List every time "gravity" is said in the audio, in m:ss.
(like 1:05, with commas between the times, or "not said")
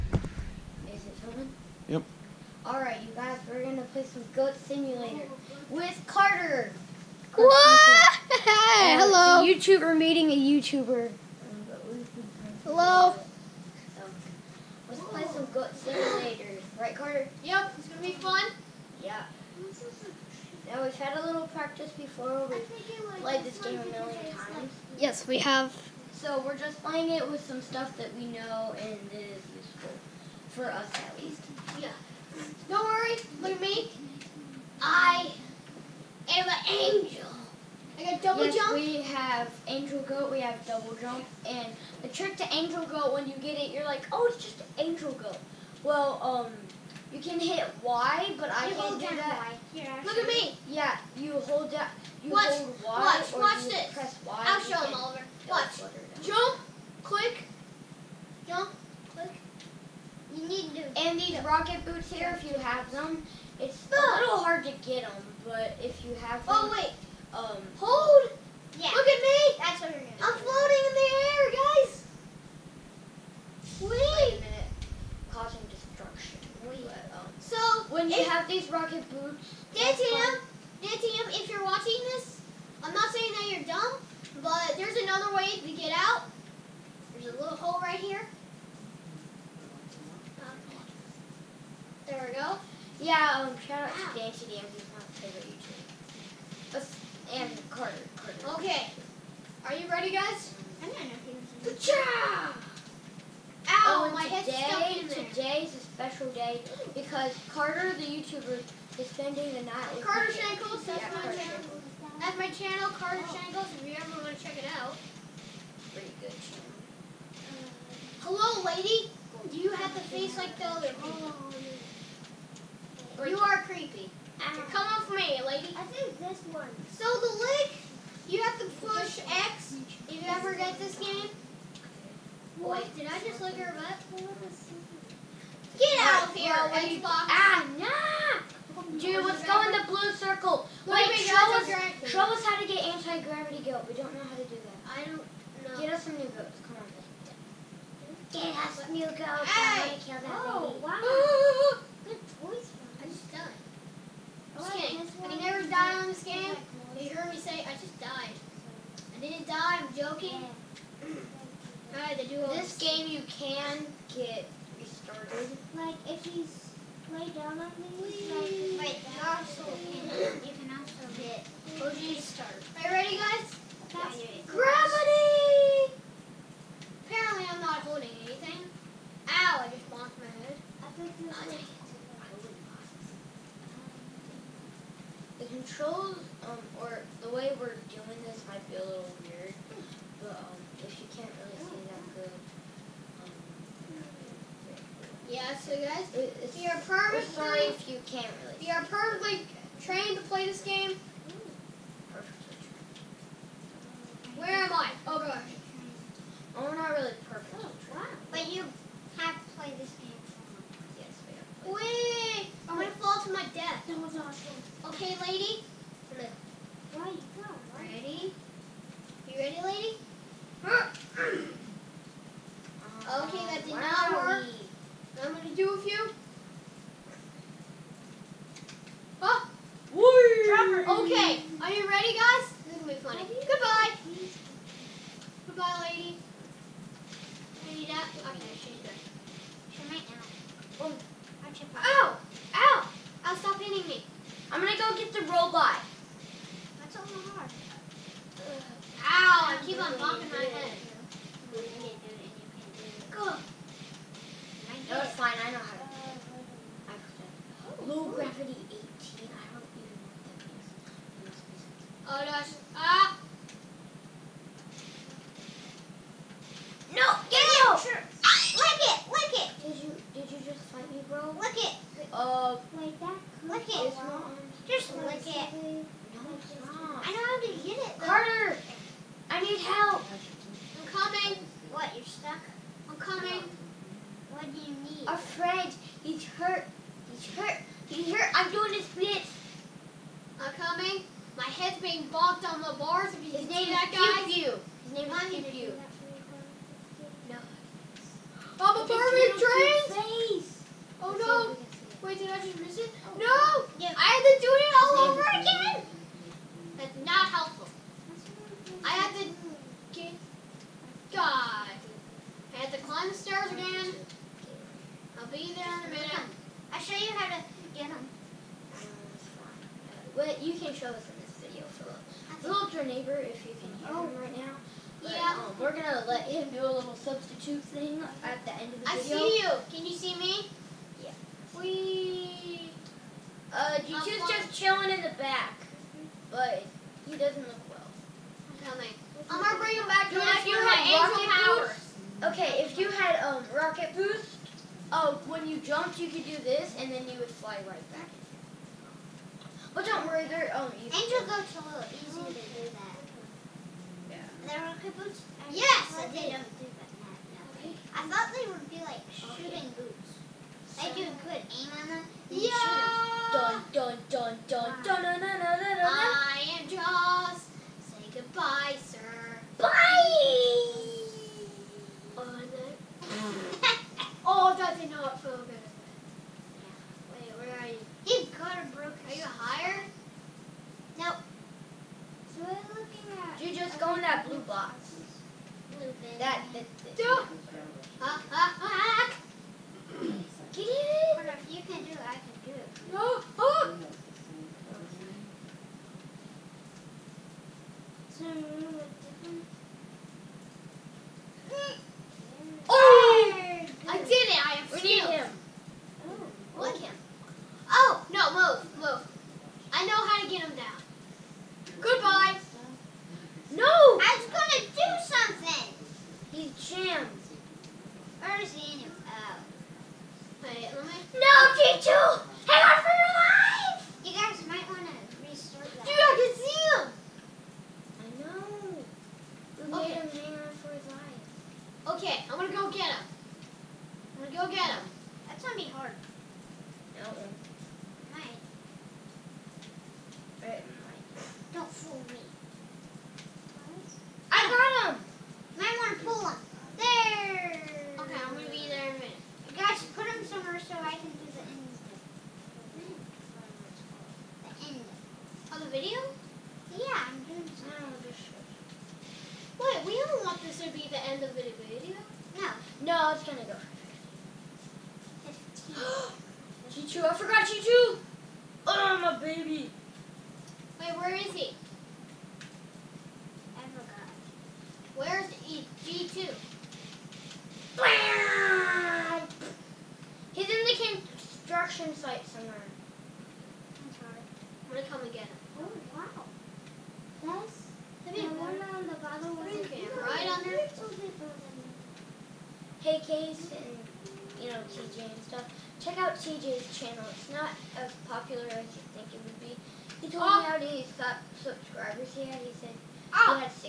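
2:22, 2:54.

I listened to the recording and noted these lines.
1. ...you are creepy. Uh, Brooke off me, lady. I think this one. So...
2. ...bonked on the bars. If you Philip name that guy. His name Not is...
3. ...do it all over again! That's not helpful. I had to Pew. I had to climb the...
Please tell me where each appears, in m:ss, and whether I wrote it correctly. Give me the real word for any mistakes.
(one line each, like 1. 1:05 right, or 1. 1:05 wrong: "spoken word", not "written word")
1. 2:03 wrong: "Come", not "Brooke"
2. 4:52 wrong: "His", not "Philip"
3. 5:04 wrong: "God", not "Pew".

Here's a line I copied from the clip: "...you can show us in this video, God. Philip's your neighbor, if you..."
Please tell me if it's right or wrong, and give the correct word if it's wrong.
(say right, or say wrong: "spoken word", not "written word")
wrong: "Philip", not "God".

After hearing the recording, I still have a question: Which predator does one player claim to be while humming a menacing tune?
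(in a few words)
Jaws.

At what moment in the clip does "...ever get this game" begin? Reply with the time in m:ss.
2:10.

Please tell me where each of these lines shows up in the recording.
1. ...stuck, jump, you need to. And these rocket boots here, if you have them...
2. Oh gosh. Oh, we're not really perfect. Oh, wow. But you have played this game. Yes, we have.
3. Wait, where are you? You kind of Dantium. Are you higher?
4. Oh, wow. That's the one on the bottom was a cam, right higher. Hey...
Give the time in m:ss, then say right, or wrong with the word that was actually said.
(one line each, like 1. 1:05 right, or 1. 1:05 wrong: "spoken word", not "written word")
1. 0:57 wrong: "click", not "stuck"
2. 3:25 right
3. 6:17 wrong: "Brooke", not "Dantium"
4. 8:05 wrong: "under", not "higher".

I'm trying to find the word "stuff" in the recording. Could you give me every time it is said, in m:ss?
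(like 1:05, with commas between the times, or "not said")
0:27, 8:15.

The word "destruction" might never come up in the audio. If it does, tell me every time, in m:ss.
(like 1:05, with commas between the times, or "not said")
1:15.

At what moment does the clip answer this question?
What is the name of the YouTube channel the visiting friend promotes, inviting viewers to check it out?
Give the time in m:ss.
1:50.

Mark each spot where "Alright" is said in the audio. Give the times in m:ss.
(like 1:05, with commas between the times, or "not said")
0:02, 2:41.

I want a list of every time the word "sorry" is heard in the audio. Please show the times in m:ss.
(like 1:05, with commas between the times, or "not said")
3:17, 8:03.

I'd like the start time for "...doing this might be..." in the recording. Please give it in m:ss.
3:07.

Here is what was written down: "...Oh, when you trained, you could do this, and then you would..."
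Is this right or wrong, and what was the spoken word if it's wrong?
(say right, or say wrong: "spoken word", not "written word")
wrong: "jumped", not "trained".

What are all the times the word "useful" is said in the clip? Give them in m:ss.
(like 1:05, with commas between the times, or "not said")
0:29.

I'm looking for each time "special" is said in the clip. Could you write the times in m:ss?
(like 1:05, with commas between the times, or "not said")
1:45.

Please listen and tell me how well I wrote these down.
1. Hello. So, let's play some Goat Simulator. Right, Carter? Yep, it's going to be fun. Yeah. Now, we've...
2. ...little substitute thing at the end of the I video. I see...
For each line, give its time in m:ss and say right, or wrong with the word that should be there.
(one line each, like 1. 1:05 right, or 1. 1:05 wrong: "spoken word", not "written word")
1. 0:12 right
2. 5:26 right.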